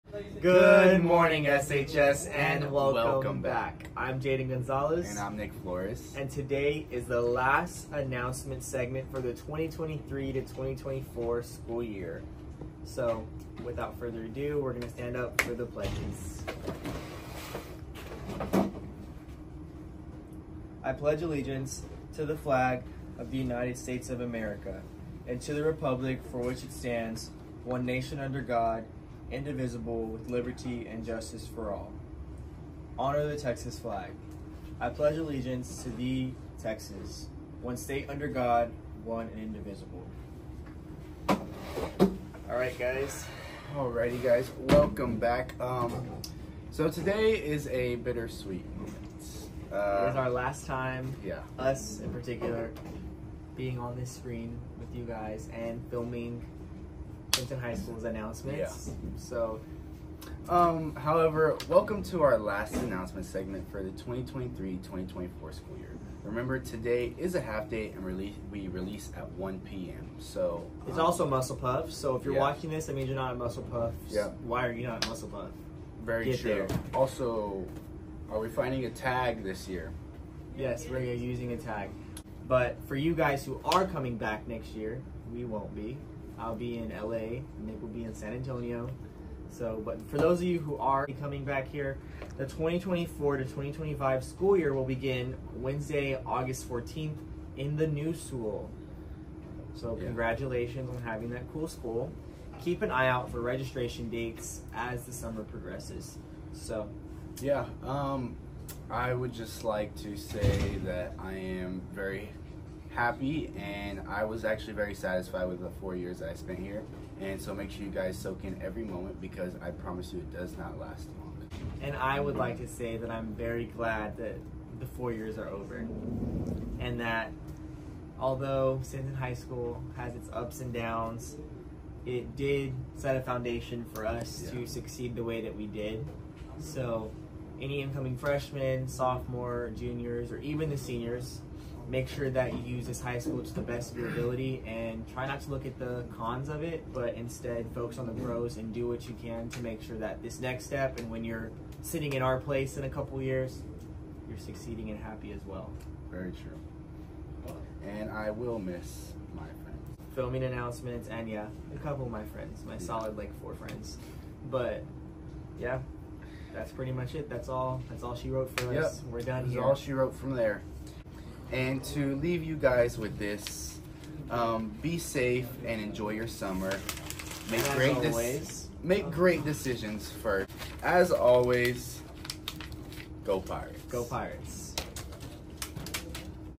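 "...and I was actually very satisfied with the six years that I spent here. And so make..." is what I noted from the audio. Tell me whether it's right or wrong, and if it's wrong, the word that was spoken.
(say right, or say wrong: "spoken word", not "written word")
wrong: "four", not "six".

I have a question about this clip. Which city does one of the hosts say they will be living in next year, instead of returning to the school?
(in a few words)
LA.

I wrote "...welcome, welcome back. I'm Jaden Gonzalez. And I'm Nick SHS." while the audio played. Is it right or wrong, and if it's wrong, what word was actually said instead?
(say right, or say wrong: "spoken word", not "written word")
wrong: "Flores", not "SHS".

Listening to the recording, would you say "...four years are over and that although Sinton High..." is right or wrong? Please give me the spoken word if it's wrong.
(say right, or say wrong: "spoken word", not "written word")
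right.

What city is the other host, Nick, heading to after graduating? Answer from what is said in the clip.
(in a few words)
San Antonio.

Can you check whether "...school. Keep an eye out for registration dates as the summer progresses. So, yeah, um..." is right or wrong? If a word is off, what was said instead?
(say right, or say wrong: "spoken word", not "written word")
right.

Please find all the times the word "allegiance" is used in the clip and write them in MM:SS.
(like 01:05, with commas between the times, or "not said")
00:21, 00:35.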